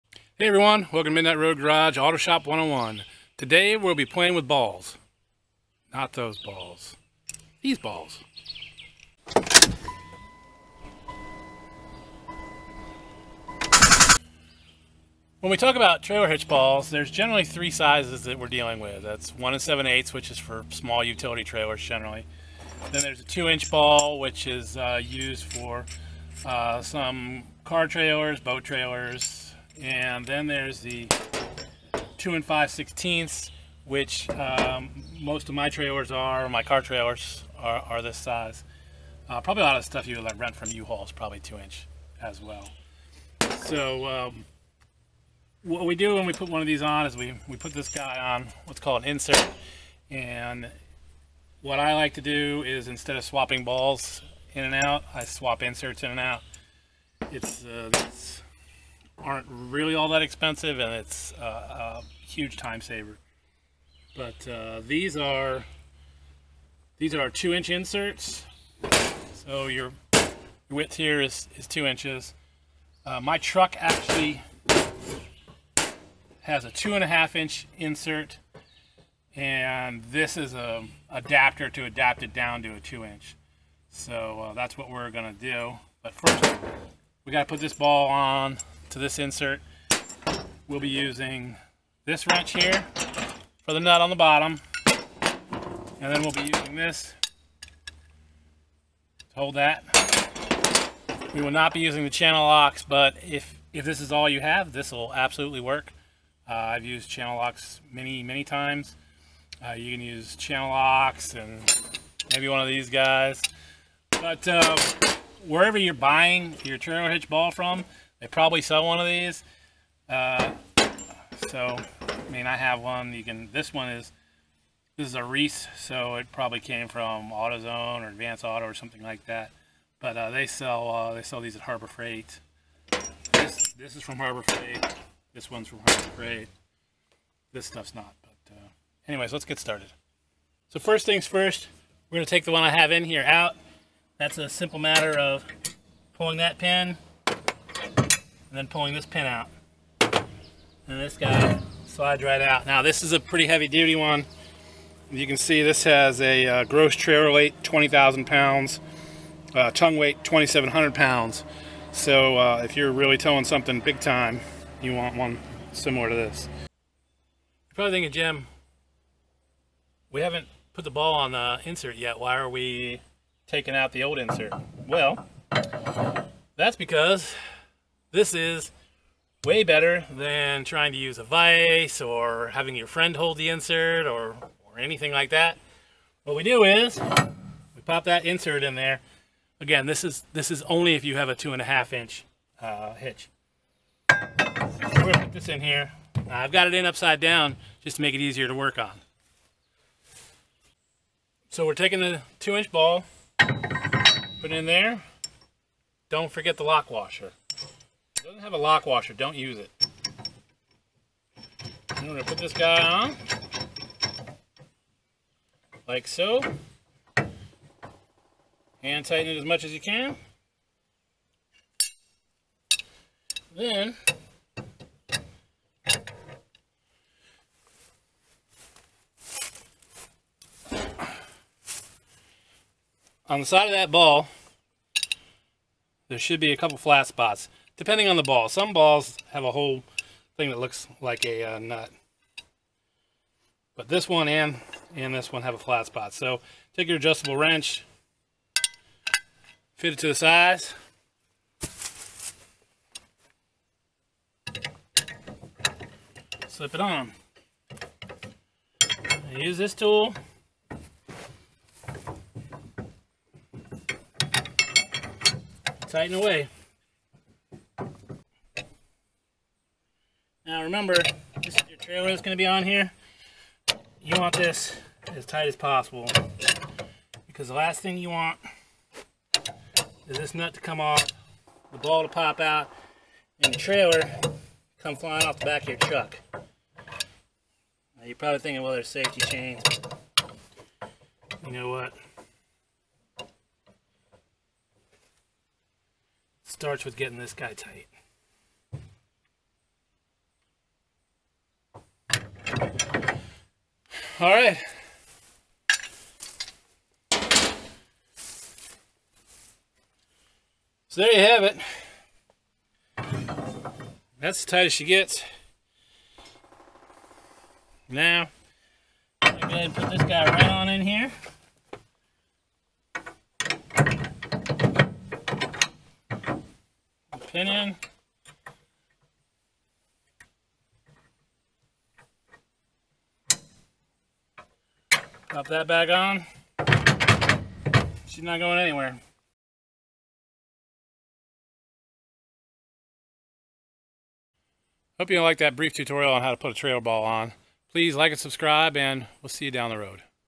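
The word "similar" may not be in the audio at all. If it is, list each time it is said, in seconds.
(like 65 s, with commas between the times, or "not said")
165 s.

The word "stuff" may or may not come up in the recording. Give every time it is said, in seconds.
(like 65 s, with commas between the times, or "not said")
39 s, 137 s.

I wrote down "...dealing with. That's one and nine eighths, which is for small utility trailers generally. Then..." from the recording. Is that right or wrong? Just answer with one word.
wrong.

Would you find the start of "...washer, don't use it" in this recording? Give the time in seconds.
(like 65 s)
208 s.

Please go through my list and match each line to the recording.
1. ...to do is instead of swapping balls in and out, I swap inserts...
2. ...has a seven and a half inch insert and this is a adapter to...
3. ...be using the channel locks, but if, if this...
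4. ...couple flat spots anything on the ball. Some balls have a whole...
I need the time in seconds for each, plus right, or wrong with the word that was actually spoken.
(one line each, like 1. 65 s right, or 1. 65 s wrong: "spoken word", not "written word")
1. 52 s right
2. 76 s wrong: "two", not "seven"
3. 101 s right
4. 236 s wrong: "depending", not "anything".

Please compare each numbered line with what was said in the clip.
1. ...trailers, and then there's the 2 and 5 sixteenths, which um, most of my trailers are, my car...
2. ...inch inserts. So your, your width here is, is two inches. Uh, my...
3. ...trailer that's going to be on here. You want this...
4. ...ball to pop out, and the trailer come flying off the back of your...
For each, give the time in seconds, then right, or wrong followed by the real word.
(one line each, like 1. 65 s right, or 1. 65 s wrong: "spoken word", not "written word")
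1. 28 s right
2. 67 s right
3. 271 s right
4. 281 s right.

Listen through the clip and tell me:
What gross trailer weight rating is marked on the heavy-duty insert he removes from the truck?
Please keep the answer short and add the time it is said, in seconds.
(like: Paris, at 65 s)
20,000 pounds, at 157 s.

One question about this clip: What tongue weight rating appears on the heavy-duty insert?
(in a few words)
2,700 pounds.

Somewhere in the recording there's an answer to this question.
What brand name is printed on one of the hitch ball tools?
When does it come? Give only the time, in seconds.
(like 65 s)
125 s.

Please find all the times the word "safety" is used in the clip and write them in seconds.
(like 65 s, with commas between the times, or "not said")
288 s.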